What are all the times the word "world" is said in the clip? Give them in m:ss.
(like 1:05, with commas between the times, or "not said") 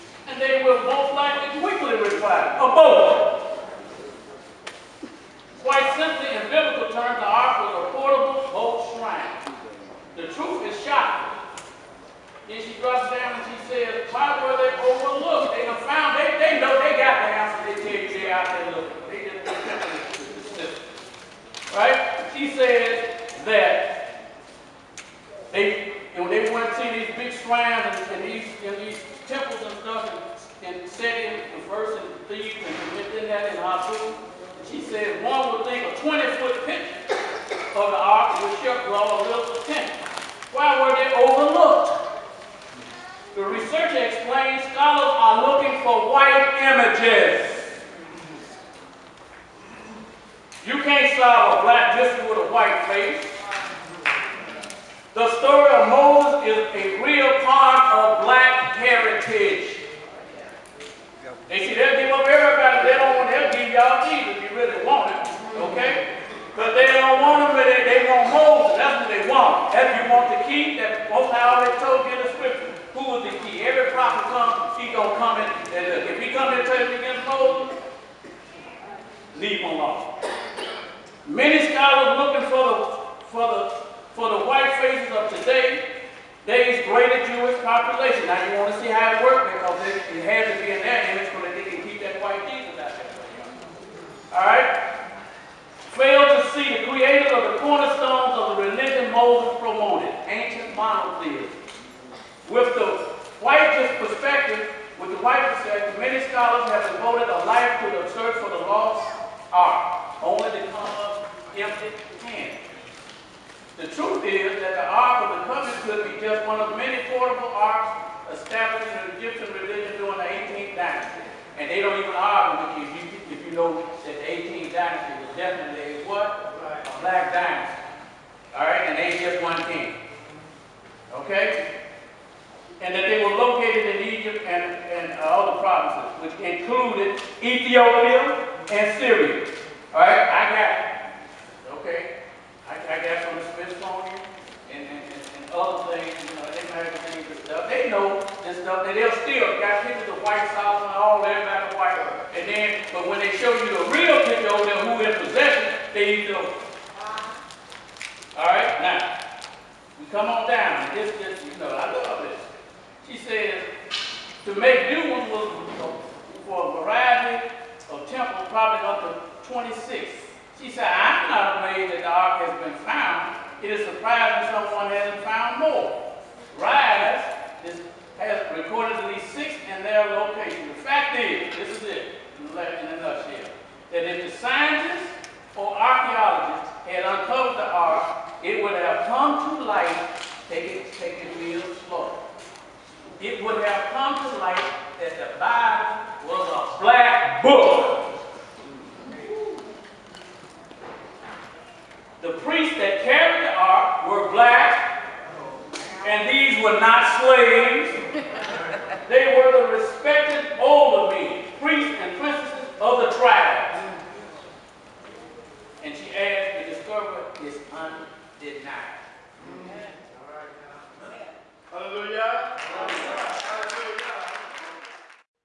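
not said.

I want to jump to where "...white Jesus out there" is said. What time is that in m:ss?
1:32.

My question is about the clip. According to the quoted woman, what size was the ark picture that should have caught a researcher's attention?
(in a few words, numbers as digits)
20-foot.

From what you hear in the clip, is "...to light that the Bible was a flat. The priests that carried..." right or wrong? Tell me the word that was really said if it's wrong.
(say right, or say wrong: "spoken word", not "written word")
right.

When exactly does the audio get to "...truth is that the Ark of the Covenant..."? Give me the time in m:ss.
1:53.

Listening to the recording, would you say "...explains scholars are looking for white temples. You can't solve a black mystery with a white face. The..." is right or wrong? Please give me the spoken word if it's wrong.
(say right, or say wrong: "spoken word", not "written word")
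wrong: "images", not "temples".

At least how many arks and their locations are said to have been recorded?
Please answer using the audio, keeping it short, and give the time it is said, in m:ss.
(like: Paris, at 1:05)
6, at 2:59.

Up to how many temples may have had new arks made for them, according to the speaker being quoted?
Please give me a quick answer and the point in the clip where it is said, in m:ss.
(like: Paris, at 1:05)
26, at 2:49.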